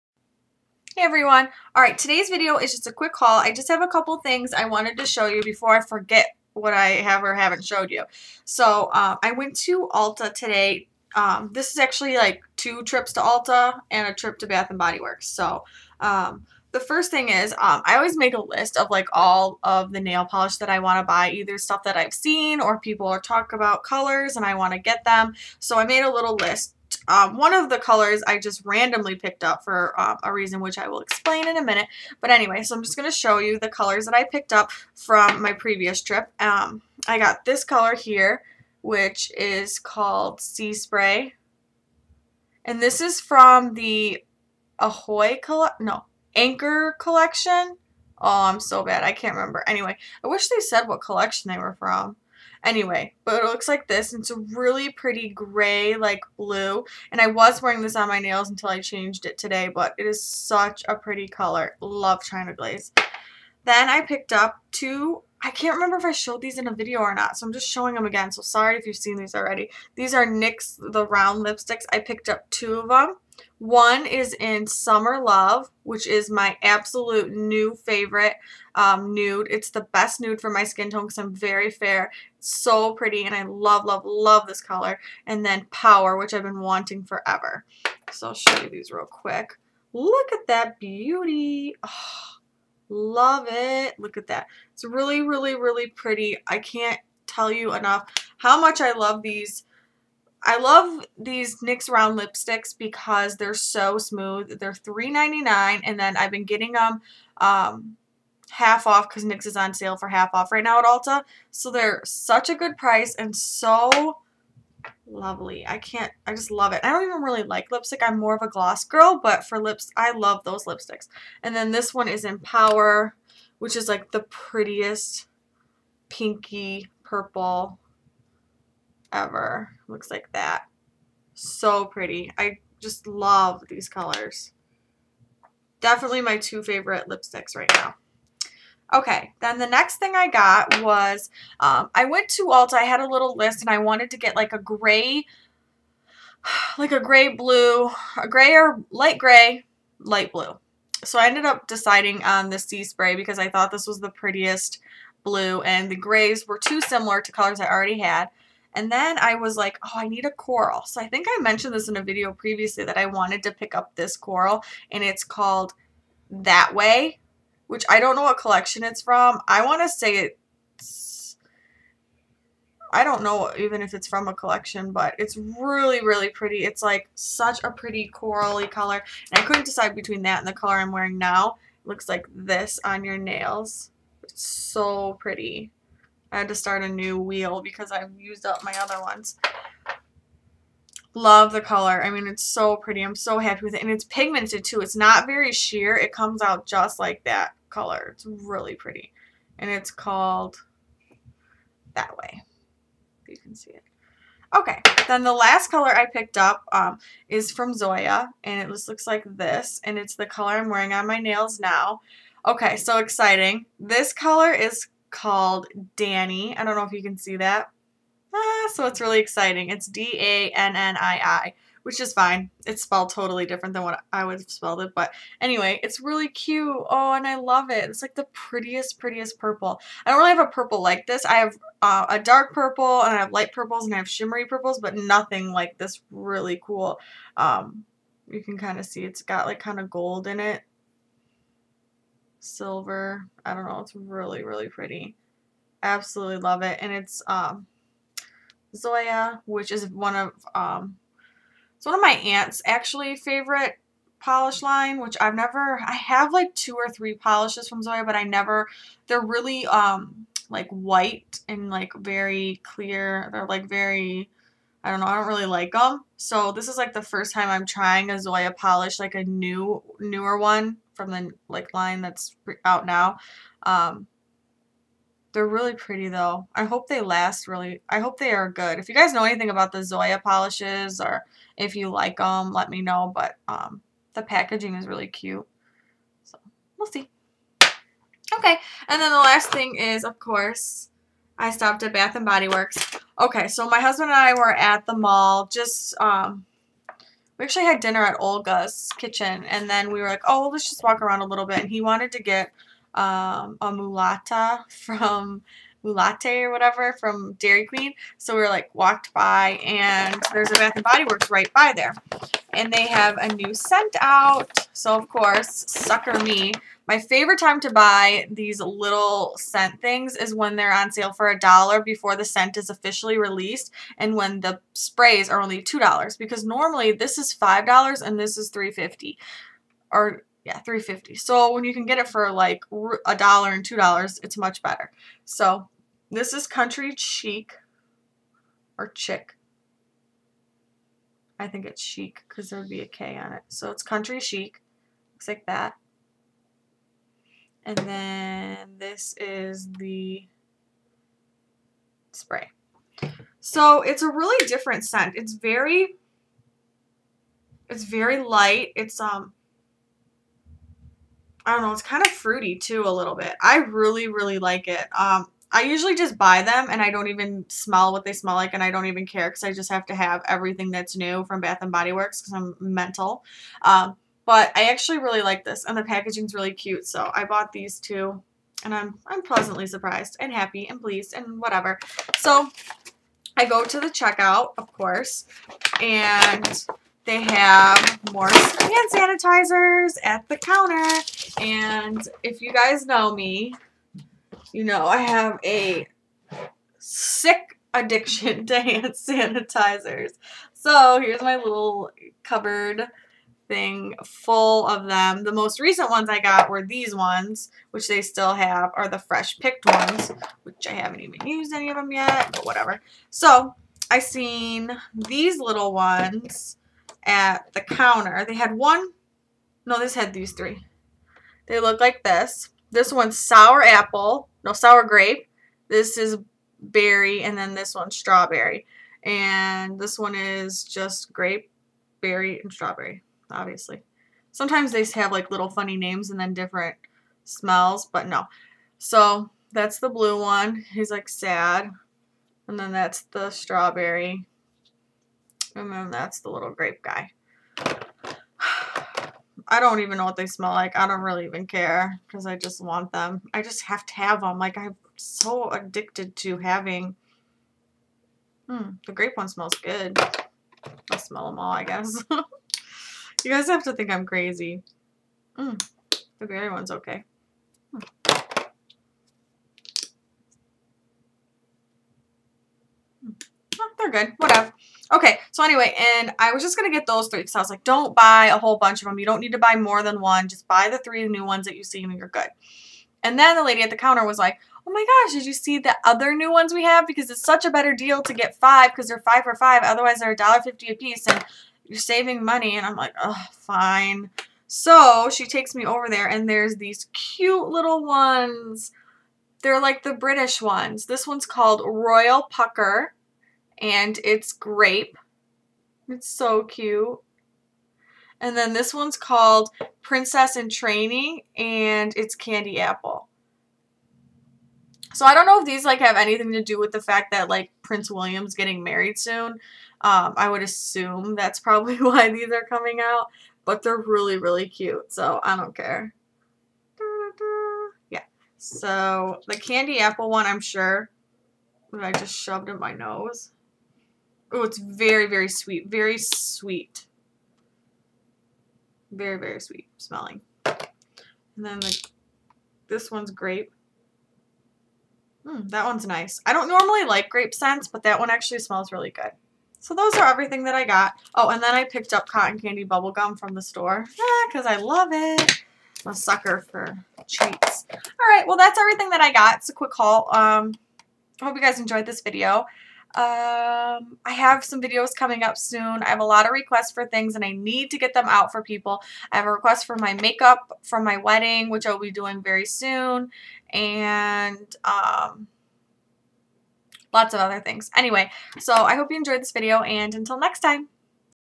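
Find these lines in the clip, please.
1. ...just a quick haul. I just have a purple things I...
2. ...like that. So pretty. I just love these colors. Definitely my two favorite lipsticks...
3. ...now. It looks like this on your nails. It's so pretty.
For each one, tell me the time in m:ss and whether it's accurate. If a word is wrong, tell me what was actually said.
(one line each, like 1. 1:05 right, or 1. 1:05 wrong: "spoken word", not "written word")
1. 0:02 wrong: "couple", not "purple"
2. 2:10 right
3. 3:01 right.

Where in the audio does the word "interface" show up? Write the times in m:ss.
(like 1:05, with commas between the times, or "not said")
not said.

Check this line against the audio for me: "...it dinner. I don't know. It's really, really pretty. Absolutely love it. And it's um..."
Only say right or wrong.
wrong.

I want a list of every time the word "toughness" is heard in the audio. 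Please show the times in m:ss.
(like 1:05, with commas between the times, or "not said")
not said.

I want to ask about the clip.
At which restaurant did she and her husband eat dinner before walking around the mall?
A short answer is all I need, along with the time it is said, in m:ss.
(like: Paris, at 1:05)
Olga's Kitchen, at 4:58.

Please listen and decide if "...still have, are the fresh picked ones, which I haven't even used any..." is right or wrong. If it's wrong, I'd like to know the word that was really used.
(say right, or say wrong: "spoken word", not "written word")
right.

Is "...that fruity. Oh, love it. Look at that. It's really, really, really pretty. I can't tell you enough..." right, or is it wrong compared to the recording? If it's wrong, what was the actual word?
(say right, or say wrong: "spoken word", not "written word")
wrong: "beauty", not "fruity".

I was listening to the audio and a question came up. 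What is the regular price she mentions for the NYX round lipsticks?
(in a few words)
$3.99.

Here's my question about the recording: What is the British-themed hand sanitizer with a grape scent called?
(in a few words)
Royal Pucker.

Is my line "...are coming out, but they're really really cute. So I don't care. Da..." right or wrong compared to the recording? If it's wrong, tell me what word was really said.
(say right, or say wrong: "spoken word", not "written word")
right.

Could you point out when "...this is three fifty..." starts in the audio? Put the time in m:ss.
5:28.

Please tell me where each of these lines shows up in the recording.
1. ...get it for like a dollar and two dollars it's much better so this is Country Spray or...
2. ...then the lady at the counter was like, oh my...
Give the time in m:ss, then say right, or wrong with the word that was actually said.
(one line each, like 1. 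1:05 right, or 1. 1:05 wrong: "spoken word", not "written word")
1. 5:31 wrong: "Chic", not "Spray"
2. 8:03 right.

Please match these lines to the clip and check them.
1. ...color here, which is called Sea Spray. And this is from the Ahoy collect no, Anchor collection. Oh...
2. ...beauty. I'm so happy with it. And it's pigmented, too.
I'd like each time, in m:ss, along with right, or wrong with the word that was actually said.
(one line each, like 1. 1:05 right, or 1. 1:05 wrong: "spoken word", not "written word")
1. 0:37 right
2. 3:12 wrong: "pretty", not "beauty".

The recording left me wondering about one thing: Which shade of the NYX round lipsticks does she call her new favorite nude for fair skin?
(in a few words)
Summer Love.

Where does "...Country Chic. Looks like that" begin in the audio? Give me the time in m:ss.
5:43.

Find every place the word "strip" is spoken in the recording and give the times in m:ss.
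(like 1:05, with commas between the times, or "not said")
not said.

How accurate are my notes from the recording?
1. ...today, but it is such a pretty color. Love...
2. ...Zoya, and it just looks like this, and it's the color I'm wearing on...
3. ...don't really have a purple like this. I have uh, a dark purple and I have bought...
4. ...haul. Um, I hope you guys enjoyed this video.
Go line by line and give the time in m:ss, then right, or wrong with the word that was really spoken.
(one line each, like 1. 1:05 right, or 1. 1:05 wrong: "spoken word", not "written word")
1. 0:59 right
2. 3:27 right
3. 3:50 wrong: "light", not "bought"
4. 9:19 right.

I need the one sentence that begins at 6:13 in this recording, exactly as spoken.
Um, but I actually really like this and the packaging's really cute.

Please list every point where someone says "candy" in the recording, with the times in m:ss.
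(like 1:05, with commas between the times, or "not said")
8:32, 8:49, 9:12.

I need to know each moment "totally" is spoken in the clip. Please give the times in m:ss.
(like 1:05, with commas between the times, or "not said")
3:43.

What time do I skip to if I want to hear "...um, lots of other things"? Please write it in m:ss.
9:34.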